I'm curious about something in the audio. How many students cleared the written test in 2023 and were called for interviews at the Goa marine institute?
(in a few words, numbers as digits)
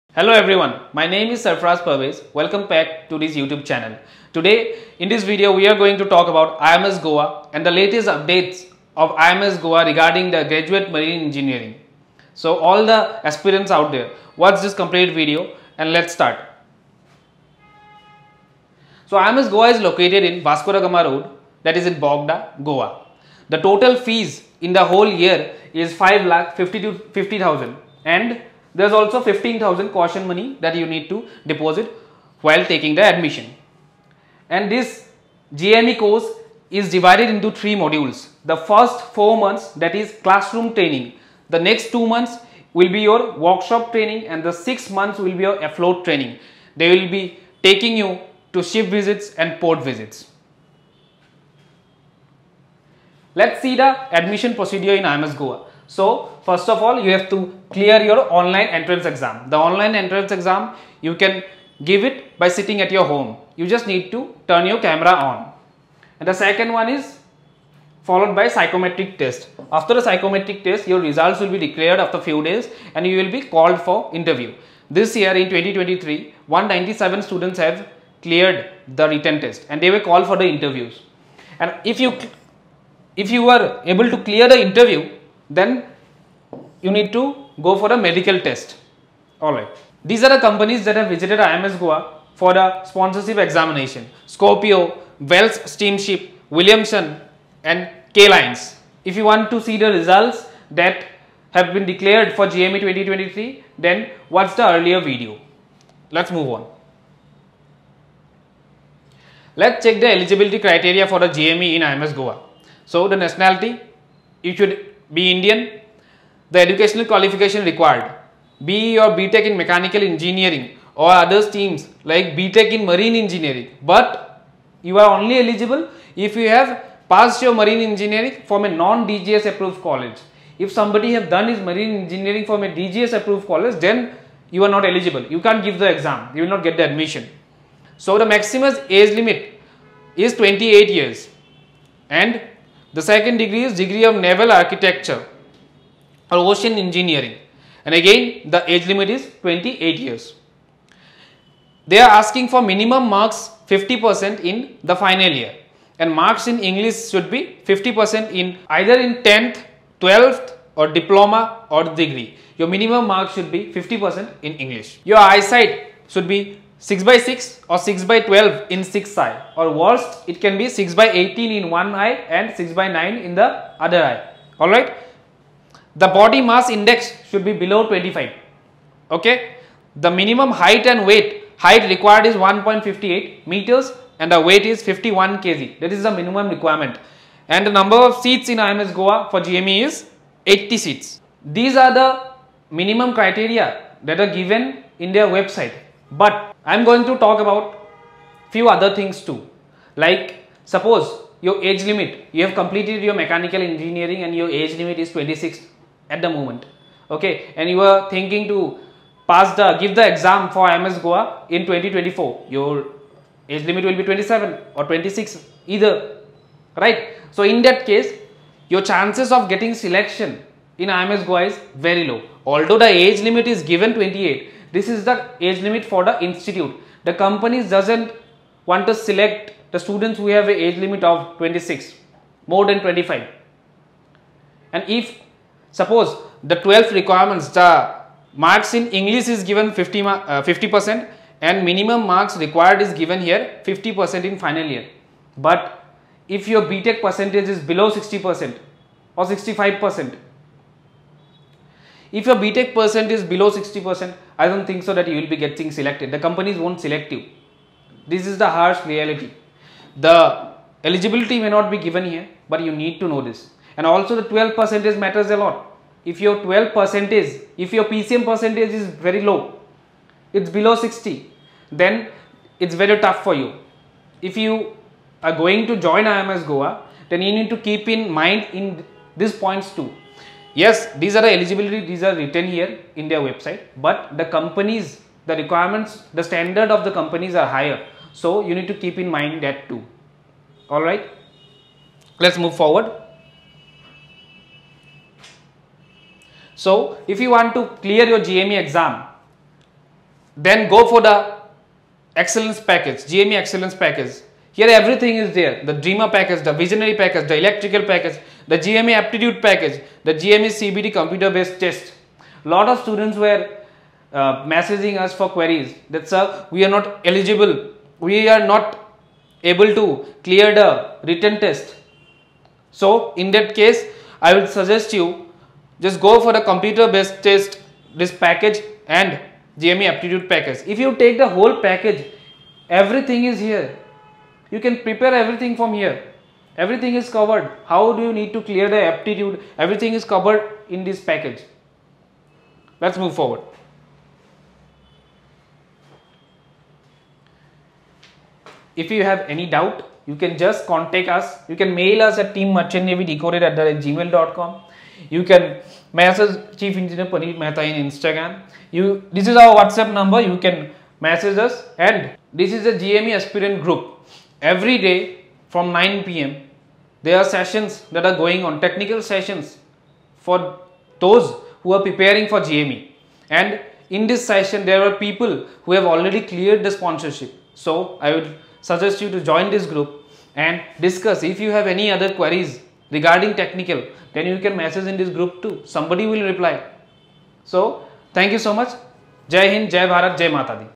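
197.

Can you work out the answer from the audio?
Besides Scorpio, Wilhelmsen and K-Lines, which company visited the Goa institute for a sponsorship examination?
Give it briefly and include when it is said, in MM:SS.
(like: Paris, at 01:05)
Wells Steamship, at 01:35.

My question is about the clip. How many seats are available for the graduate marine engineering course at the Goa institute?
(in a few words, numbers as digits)
80.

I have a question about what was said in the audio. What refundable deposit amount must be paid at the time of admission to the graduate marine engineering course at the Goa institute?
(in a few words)
15,000.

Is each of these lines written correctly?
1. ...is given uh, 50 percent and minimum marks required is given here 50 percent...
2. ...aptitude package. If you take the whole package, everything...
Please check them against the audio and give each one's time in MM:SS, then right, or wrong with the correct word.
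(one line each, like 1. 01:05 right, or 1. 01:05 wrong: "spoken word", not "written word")
1. 03:59 right
2. 05:29 right.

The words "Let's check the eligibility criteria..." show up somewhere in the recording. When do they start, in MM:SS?
01:49.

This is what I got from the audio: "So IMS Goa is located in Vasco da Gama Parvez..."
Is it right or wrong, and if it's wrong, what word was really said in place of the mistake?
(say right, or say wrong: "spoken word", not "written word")
wrong: "Road", not "Parvez".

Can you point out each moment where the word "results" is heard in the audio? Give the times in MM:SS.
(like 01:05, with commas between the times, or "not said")
01:11, 01:39.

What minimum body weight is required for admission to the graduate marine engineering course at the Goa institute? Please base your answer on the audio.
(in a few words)
51 kg.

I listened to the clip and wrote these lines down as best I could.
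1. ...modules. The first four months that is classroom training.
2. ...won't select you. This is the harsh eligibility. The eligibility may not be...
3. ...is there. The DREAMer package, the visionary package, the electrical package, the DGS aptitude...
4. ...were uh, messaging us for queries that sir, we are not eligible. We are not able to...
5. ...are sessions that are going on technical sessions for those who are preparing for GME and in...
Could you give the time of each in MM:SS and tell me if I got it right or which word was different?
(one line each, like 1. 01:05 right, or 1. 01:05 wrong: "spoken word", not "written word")
1. 00:37 right
2. 04:16 wrong: "reality", not "eligibility"
3. 05:05 wrong: "GME", not "DGS"
4. 05:13 right
5. 06:07 right.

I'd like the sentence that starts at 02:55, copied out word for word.
The body mass index should be below 25 okay.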